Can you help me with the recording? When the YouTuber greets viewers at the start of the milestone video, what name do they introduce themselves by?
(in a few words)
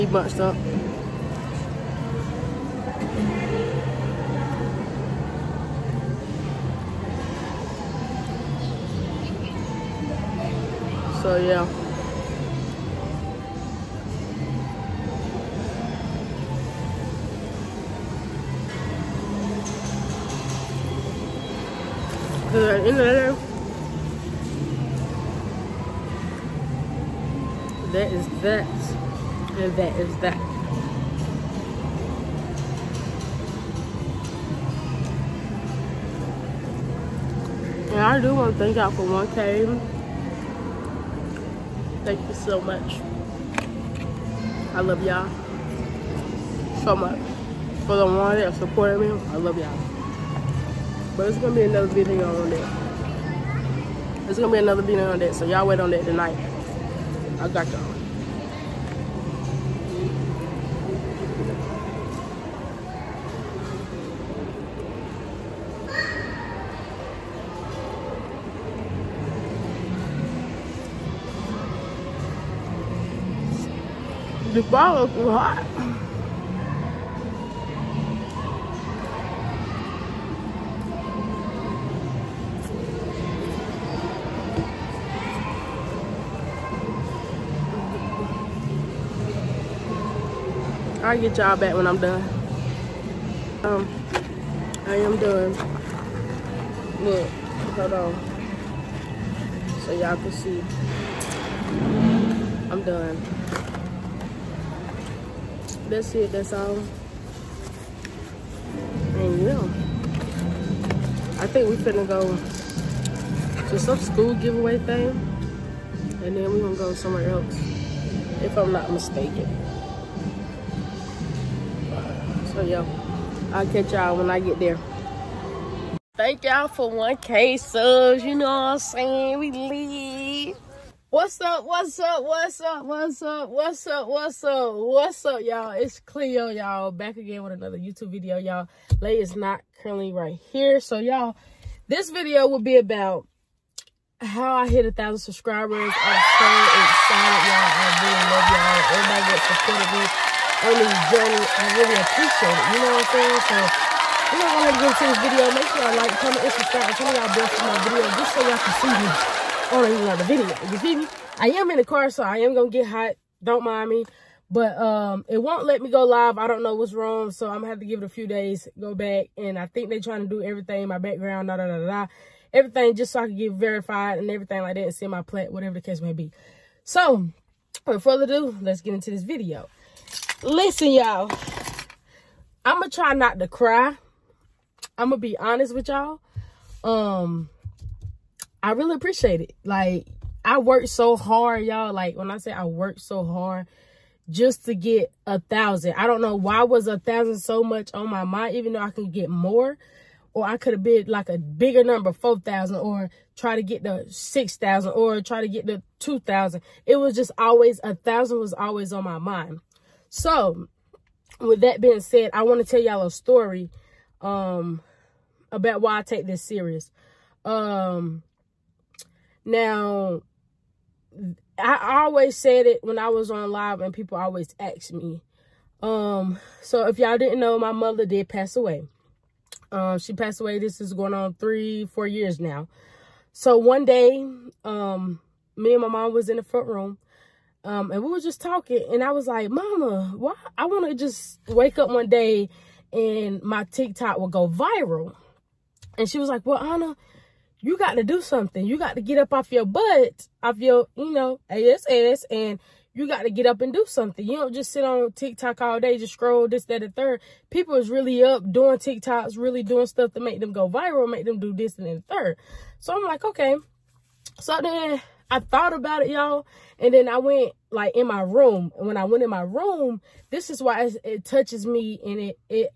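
Cleo.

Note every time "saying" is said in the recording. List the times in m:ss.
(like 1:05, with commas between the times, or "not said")
2:08, 2:33.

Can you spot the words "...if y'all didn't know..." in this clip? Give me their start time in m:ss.
3:46.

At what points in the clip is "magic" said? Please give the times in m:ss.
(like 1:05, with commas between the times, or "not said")
not said.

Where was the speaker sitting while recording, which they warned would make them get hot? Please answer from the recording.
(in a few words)
in the car.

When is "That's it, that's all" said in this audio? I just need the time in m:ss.
1:45.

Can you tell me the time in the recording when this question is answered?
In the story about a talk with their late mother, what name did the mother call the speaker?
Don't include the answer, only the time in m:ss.
4:06.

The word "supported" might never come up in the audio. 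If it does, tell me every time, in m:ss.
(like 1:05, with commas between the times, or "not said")
0:48, 2:29.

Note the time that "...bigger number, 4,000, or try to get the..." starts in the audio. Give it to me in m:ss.
3:21.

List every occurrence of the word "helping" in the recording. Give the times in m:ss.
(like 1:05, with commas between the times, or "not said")
not said.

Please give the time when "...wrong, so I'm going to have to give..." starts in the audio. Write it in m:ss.
2:46.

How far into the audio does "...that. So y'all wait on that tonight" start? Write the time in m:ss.
0:55.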